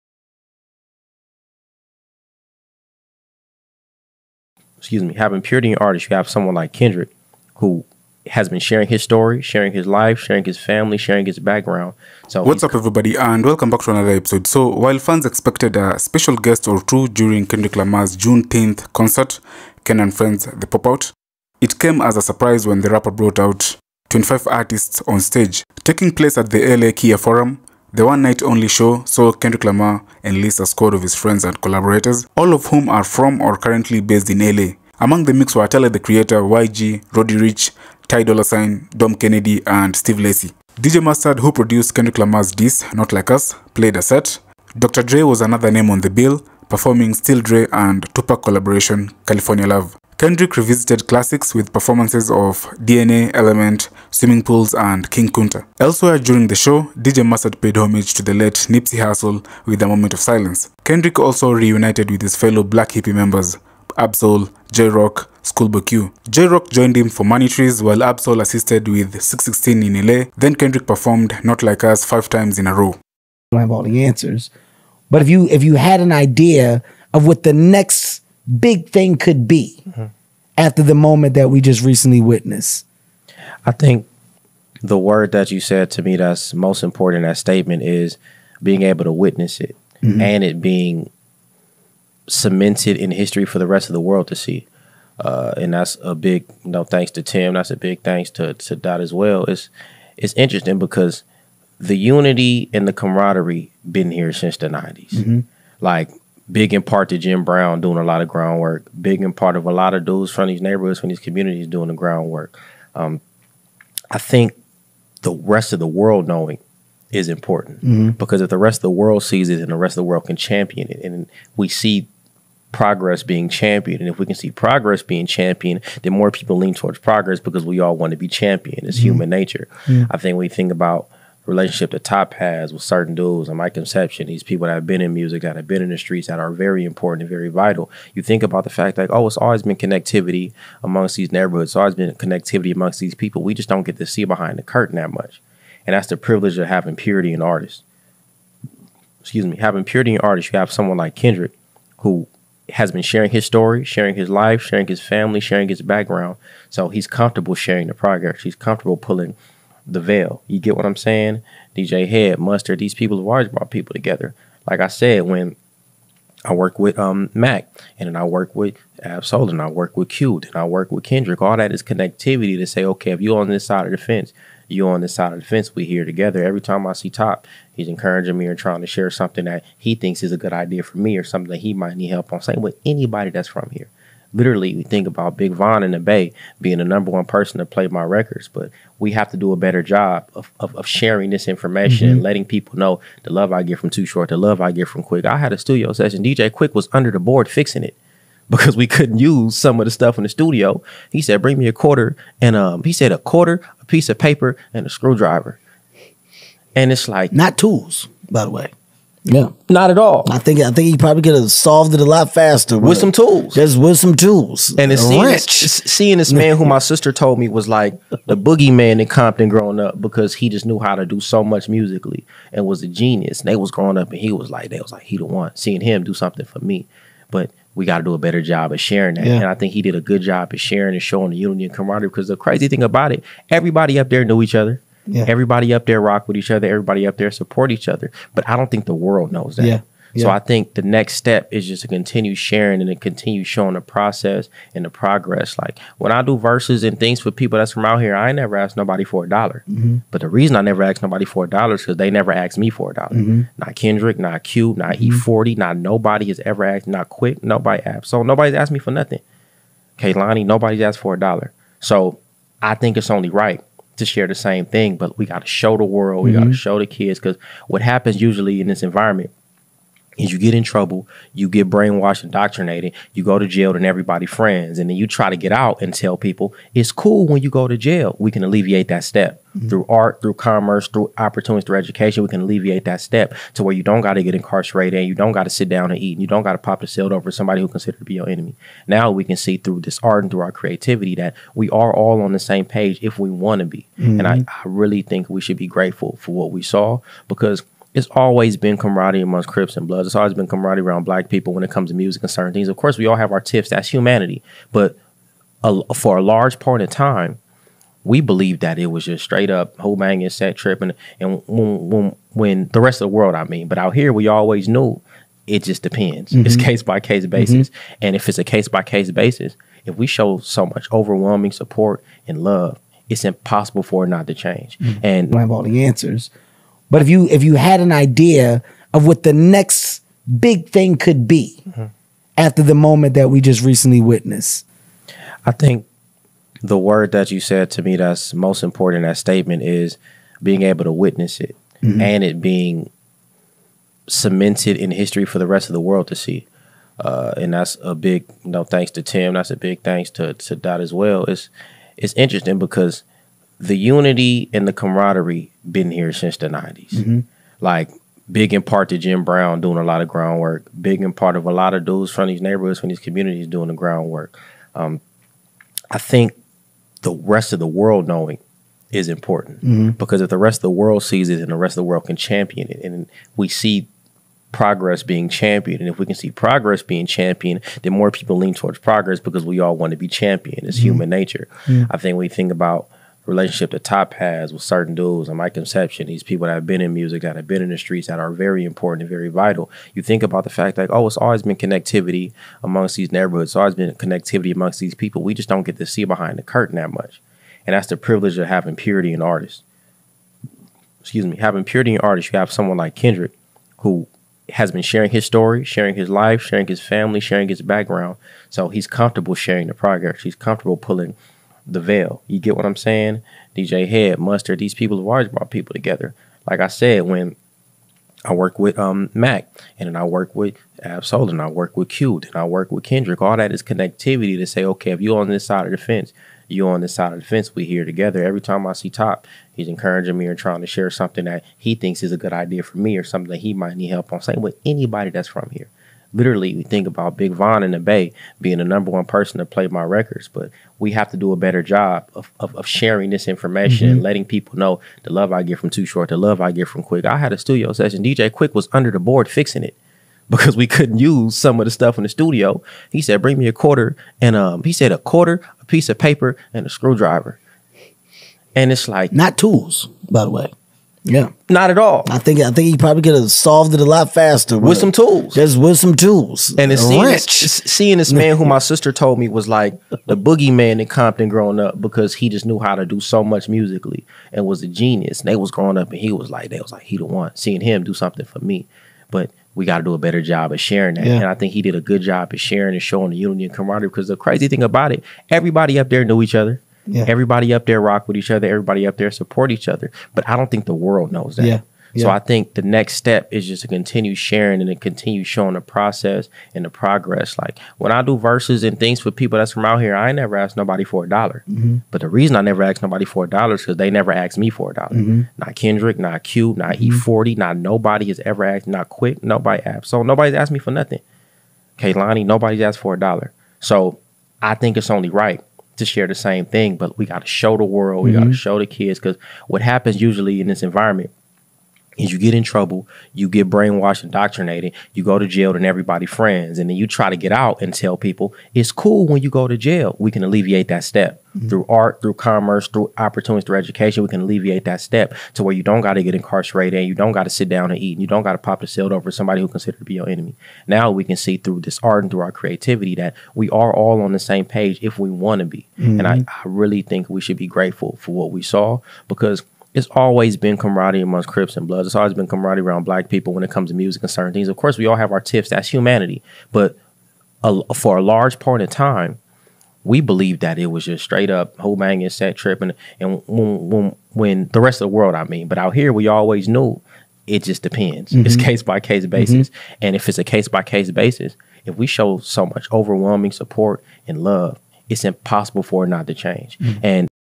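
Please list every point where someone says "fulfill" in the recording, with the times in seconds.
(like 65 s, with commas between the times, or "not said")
not said.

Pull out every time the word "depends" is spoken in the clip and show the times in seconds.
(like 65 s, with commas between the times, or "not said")
315 s, 567 s.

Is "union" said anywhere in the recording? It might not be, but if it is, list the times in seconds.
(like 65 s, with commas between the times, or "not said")
483 s.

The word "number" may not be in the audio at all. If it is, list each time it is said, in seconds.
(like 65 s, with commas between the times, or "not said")
186 s, 438 s.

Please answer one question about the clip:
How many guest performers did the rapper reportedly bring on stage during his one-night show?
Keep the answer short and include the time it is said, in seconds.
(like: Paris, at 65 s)
25, at 24 s.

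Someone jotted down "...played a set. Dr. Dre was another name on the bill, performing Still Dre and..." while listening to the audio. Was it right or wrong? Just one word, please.
right.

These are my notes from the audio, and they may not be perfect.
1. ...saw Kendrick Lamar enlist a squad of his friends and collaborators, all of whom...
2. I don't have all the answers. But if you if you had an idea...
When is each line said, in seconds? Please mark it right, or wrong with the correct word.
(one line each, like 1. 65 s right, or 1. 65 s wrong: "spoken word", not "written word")
1. 29 s right
2. 72 s right.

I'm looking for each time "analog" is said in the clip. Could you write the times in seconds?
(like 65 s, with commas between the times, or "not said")
not said.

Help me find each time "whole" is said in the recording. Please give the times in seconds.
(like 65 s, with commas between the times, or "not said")
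309 s, 561 s.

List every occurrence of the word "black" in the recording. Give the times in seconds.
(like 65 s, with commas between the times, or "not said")
62 s, 301 s, 552 s.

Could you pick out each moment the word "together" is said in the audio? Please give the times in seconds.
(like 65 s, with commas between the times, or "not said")
163 s, 176 s, 415 s, 427 s.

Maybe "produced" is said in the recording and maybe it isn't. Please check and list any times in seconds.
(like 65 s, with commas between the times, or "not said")
41 s.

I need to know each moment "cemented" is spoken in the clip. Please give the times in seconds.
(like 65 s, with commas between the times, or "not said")
92 s, 344 s.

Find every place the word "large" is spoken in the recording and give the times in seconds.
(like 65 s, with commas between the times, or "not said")
306 s, 558 s.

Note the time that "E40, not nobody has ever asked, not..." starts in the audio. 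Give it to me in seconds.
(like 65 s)
506 s.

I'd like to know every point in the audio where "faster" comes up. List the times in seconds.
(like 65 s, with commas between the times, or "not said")
212 s, 464 s.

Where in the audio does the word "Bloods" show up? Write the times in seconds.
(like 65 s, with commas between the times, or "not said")
299 s, 551 s.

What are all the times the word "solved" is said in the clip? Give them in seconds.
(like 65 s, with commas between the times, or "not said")
211 s, 463 s.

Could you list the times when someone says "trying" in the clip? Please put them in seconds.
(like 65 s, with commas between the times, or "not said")
178 s, 430 s.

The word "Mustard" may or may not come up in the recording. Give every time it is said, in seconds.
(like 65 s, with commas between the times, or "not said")
41 s, 57 s, 162 s, 414 s.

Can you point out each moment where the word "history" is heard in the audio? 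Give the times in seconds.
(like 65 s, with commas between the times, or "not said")
93 s, 344 s.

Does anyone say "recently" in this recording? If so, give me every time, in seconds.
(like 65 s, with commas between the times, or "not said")
81 s, 333 s.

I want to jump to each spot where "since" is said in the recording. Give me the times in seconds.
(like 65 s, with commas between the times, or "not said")
104 s, 356 s.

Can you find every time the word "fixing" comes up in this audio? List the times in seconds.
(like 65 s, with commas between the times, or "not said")
197 s, 449 s.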